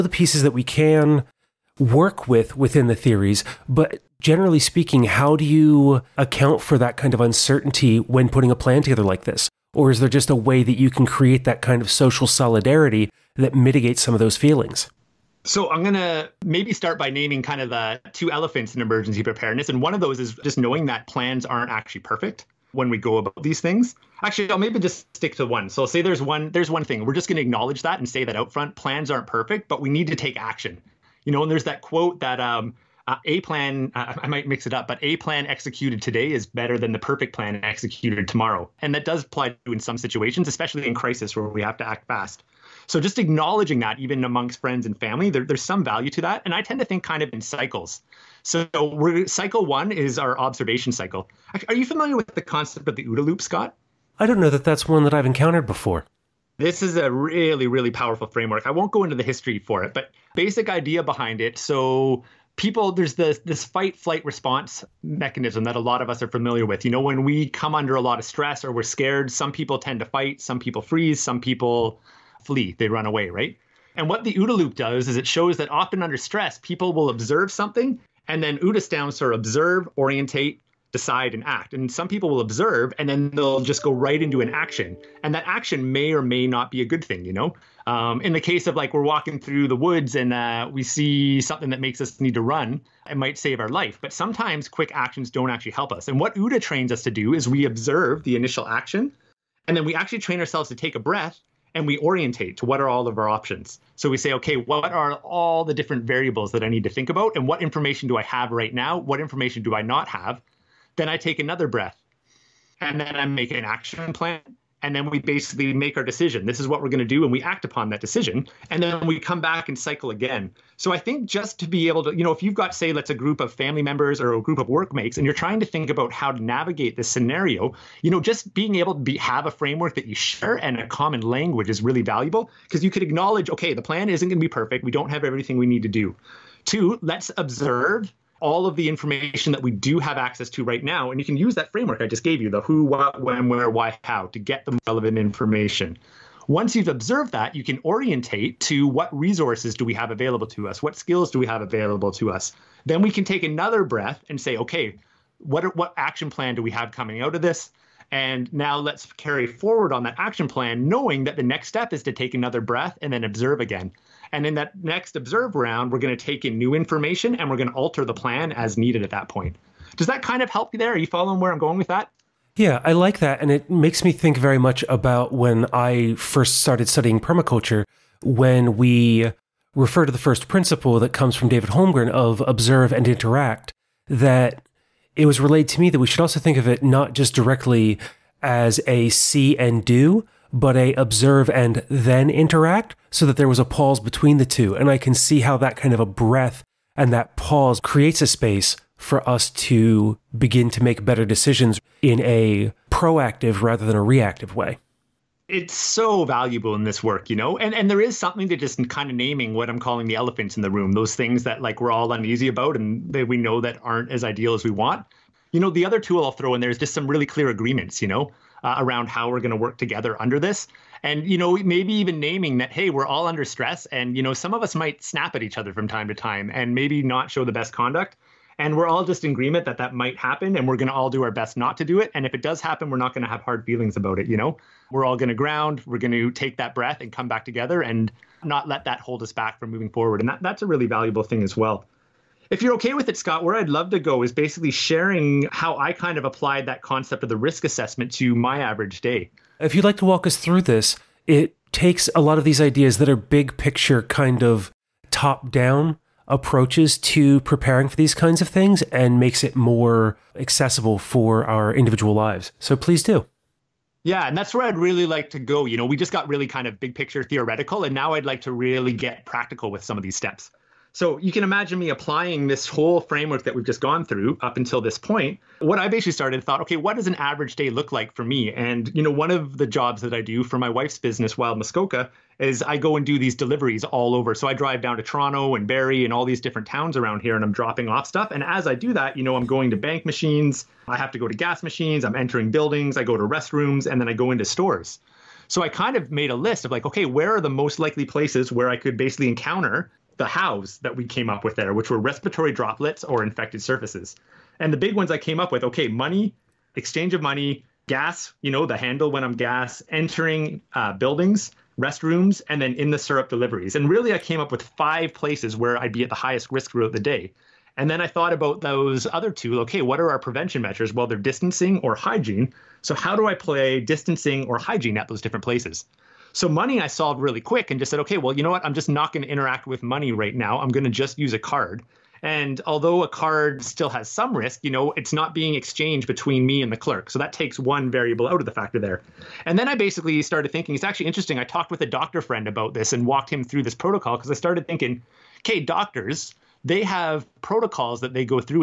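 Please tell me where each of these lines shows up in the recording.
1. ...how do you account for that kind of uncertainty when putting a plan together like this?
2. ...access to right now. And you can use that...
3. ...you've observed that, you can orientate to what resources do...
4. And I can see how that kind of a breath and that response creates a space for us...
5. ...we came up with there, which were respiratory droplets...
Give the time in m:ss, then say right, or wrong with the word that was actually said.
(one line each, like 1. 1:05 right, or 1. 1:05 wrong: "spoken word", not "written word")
1. 0:05 right
2. 2:20 right
3. 2:26 right
4. 3:14 wrong: "pause", not "response"
5. 5:00 right.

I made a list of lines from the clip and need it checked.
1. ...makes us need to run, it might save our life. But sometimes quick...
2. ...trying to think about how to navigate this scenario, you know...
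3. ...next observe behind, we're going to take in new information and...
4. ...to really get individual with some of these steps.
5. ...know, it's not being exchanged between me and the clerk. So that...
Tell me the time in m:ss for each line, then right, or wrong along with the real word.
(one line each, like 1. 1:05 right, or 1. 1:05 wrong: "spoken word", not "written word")
1. 1:31 right
2. 2:05 right
3. 2:44 wrong: "round", not "behind"
4. 4:28 wrong: "practical", not "individual"
5. 5:34 right.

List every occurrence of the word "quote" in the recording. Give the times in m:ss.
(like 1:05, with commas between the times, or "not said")
0:31.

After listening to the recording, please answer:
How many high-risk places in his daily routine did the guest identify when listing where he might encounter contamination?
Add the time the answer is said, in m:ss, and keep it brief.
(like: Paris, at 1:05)
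5, at 5:14.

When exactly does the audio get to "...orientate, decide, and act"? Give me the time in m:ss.
1:19.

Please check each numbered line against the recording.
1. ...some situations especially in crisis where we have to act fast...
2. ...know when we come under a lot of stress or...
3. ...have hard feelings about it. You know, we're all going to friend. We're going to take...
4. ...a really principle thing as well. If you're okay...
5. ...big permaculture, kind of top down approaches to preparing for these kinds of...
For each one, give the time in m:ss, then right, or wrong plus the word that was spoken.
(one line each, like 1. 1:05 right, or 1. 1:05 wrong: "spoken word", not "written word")
1. 0:39 right
2. 1:06 right
3. 3:53 wrong: "ground", not "friend"
4. 4:00 wrong: "valuable", not "principle"
5. 4:13 wrong: "picture", not "permaculture".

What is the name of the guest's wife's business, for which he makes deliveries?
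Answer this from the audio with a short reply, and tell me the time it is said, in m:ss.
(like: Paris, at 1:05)
Wild Muskoka, at 4:41.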